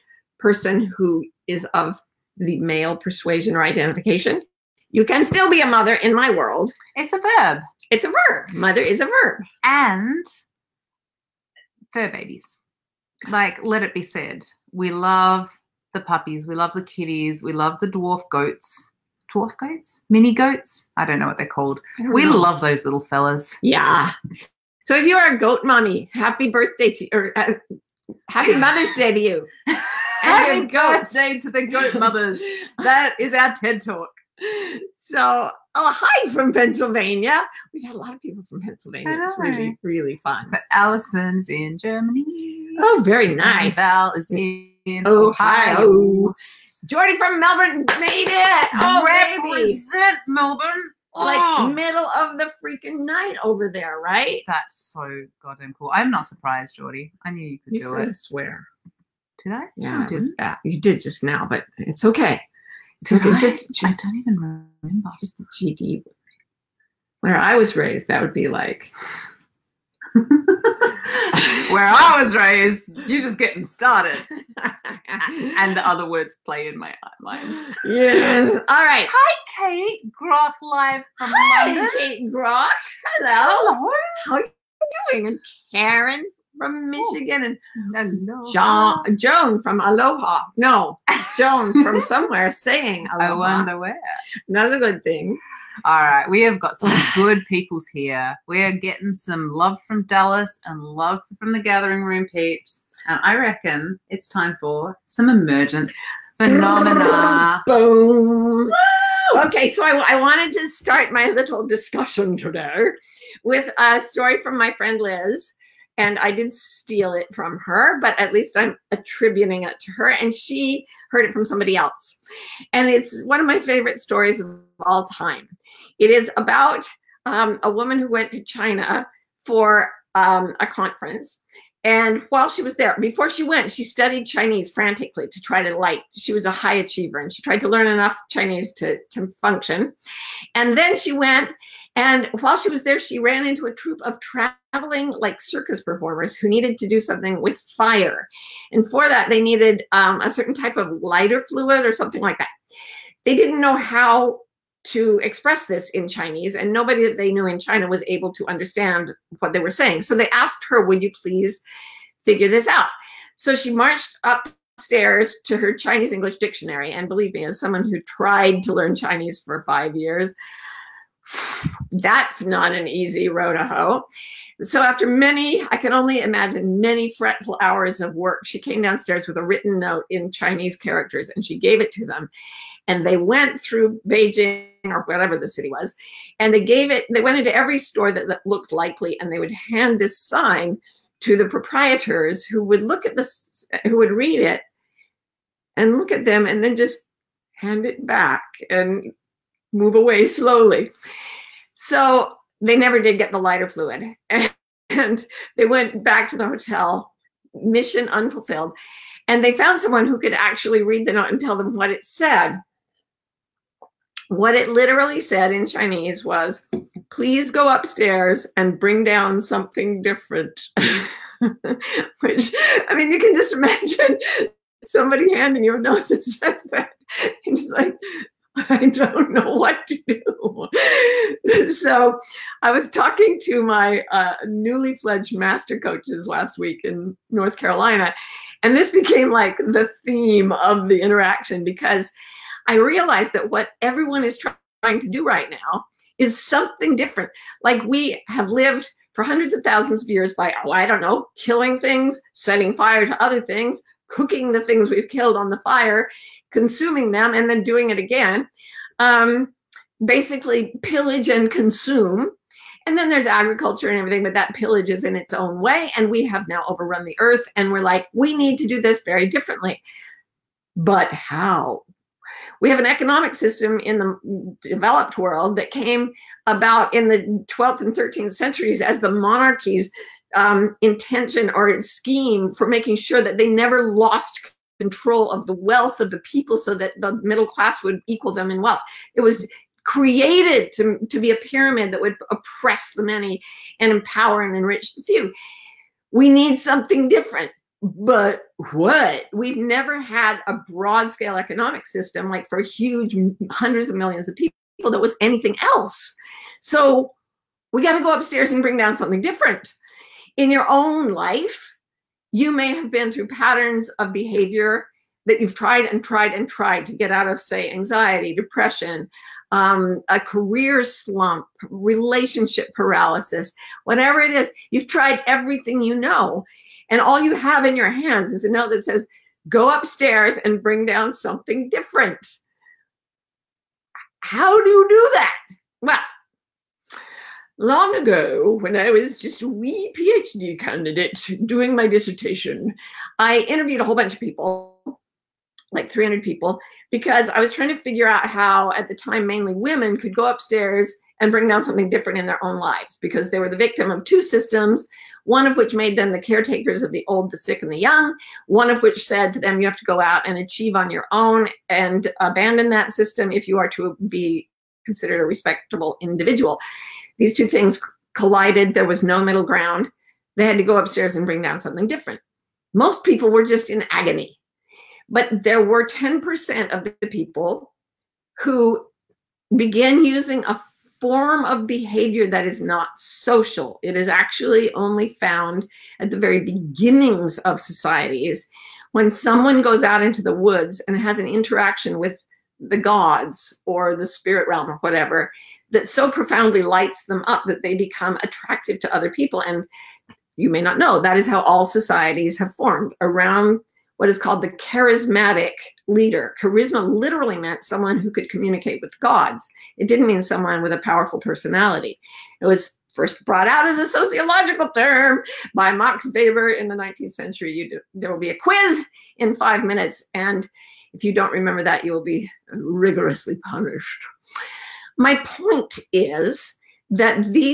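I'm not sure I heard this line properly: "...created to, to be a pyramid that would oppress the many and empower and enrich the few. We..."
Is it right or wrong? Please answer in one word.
right.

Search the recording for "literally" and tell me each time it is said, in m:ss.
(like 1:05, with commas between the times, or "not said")
3:34, 6:46.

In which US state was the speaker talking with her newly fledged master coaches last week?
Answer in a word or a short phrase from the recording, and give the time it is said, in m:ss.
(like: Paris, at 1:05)
North Carolina, at 3:57.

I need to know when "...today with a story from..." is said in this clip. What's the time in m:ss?
1:52.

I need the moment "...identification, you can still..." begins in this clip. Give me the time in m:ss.
0:03.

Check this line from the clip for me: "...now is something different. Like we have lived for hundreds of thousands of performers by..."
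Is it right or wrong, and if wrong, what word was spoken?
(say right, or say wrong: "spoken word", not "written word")
wrong: "years", not "performers".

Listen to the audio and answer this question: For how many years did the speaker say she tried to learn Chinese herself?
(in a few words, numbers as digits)
5.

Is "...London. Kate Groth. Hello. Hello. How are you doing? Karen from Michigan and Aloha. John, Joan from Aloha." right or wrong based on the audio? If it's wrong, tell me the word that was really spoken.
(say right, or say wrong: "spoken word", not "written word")
right.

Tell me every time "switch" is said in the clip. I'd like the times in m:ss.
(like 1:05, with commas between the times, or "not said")
not said.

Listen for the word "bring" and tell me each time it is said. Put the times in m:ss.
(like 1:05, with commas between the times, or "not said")
3:38, 5:08, 5:30, 5:51, 6:11.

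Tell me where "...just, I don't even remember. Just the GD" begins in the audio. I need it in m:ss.
1:03.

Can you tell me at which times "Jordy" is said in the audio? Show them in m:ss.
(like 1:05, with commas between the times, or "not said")
0:46, 0:56.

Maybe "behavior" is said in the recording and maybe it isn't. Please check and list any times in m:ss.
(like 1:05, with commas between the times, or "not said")
5:14, 6:21.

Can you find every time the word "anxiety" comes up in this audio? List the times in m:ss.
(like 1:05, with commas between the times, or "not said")
5:17.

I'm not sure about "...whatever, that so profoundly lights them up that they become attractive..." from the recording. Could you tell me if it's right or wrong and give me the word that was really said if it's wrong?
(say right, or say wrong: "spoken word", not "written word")
right.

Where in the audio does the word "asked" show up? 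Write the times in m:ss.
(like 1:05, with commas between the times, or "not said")
2:40.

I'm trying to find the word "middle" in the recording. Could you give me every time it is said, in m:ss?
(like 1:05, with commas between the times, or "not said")
0:51, 4:47, 6:09.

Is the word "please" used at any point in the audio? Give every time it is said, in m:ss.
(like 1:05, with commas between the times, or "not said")
2:41, 3:37.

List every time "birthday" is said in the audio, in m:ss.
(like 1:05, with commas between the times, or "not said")
0:26, 0:31.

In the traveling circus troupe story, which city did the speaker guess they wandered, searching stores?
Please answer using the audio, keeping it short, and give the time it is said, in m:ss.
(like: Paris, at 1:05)
Beijing, at 3:04.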